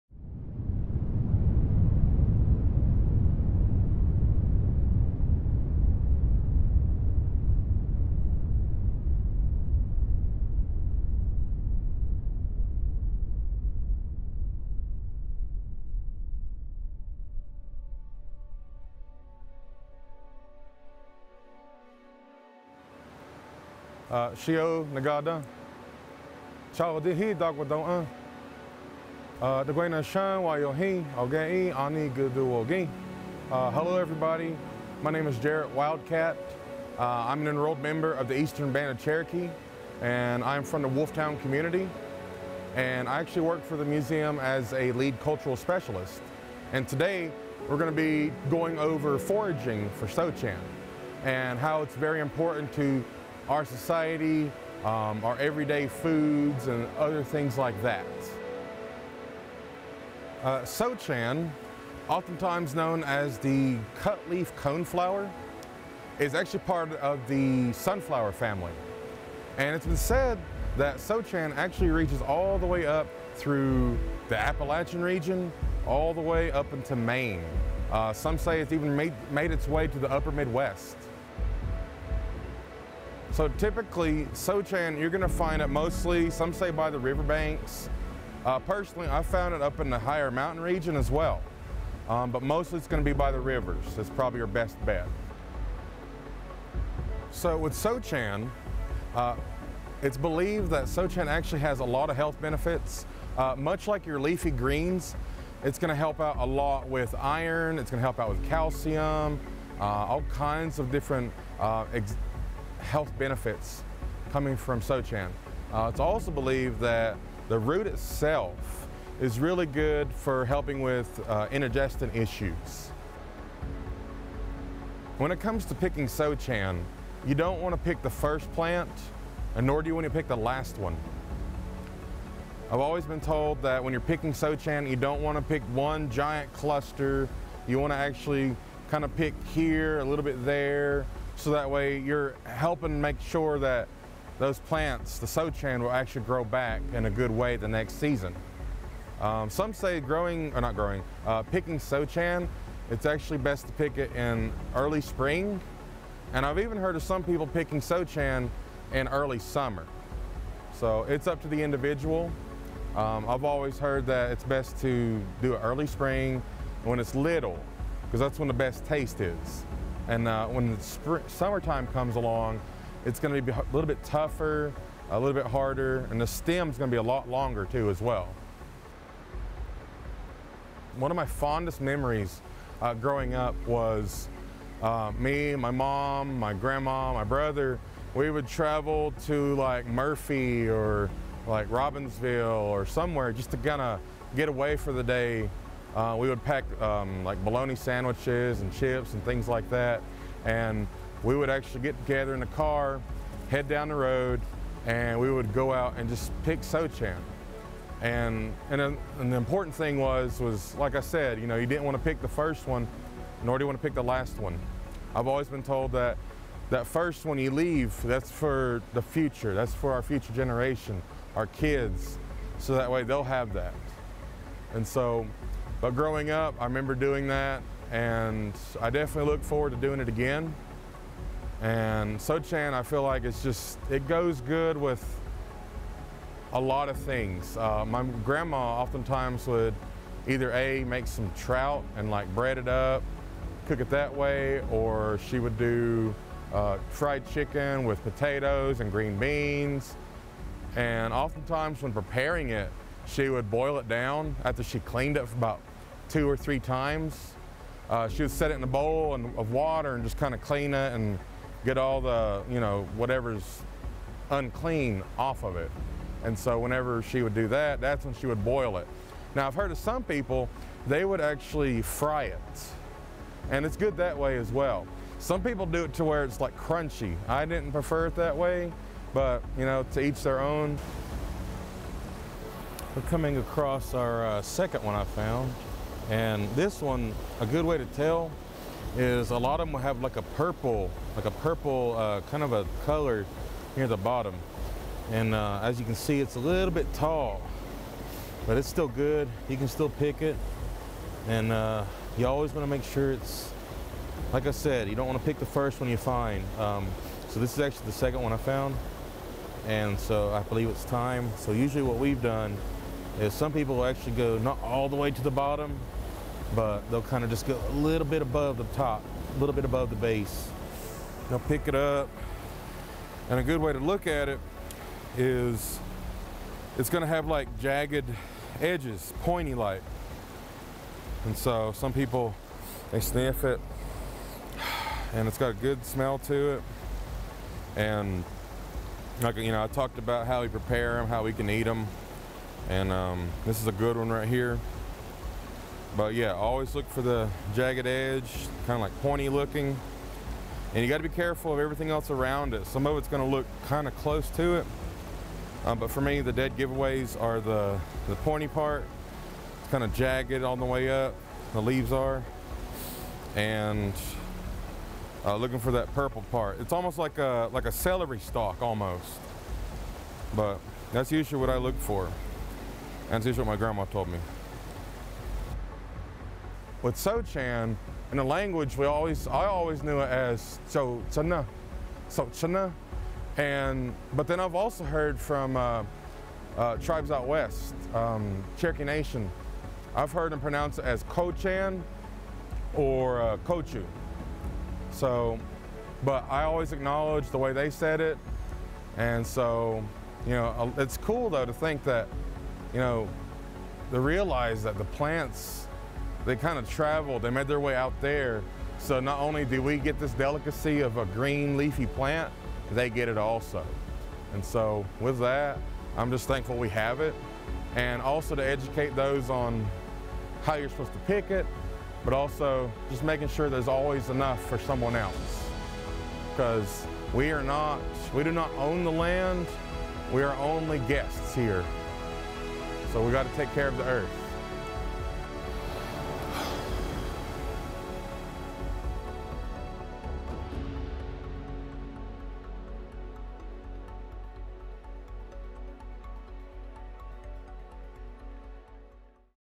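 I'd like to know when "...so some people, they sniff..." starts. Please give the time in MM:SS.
05:31.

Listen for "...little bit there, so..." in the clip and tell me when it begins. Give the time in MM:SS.
02:20.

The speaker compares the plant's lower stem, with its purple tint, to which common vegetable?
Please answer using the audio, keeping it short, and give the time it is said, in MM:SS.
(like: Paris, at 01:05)
celery, at 06:07.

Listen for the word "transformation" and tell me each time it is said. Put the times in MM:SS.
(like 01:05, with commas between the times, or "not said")
not said.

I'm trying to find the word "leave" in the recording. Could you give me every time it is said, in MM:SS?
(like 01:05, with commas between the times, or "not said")
03:37, 06:01.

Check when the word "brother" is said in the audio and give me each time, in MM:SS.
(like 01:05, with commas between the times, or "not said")
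03:07.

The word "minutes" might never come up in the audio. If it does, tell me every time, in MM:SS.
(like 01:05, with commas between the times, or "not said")
not said.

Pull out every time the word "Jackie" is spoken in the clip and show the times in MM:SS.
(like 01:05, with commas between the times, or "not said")
not said.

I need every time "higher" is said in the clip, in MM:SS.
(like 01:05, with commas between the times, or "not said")
01:29.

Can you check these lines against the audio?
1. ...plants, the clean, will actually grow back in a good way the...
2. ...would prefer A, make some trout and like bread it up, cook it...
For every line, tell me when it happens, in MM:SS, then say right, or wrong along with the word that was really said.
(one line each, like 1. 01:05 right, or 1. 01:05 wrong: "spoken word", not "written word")
1. 02:24 wrong: "sochan", not "clean"
2. 03:59 wrong: "either", not "prefer".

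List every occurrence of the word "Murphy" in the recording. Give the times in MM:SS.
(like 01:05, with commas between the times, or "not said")
03:09.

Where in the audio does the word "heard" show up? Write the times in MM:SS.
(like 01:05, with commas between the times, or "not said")
02:36, 02:43, 04:29, 06:24, 06:30.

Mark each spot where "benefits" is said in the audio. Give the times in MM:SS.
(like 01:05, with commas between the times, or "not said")
01:42, 01:53.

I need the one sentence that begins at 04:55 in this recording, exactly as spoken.
And uh, as you can see, it's a little bit tall, but it's still good.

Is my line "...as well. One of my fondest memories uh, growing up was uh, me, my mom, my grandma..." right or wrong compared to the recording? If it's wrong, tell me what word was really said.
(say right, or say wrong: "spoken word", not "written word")
right.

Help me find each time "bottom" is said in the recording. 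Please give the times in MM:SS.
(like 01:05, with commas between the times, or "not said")
04:53, 05:15.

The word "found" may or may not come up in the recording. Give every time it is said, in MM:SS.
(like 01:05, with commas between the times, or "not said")
01:29, 04:45, 05:08.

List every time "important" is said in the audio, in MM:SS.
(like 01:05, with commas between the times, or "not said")
00:52, 03:29.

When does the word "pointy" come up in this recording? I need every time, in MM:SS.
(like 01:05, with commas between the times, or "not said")
05:29, 05:49, 05:58.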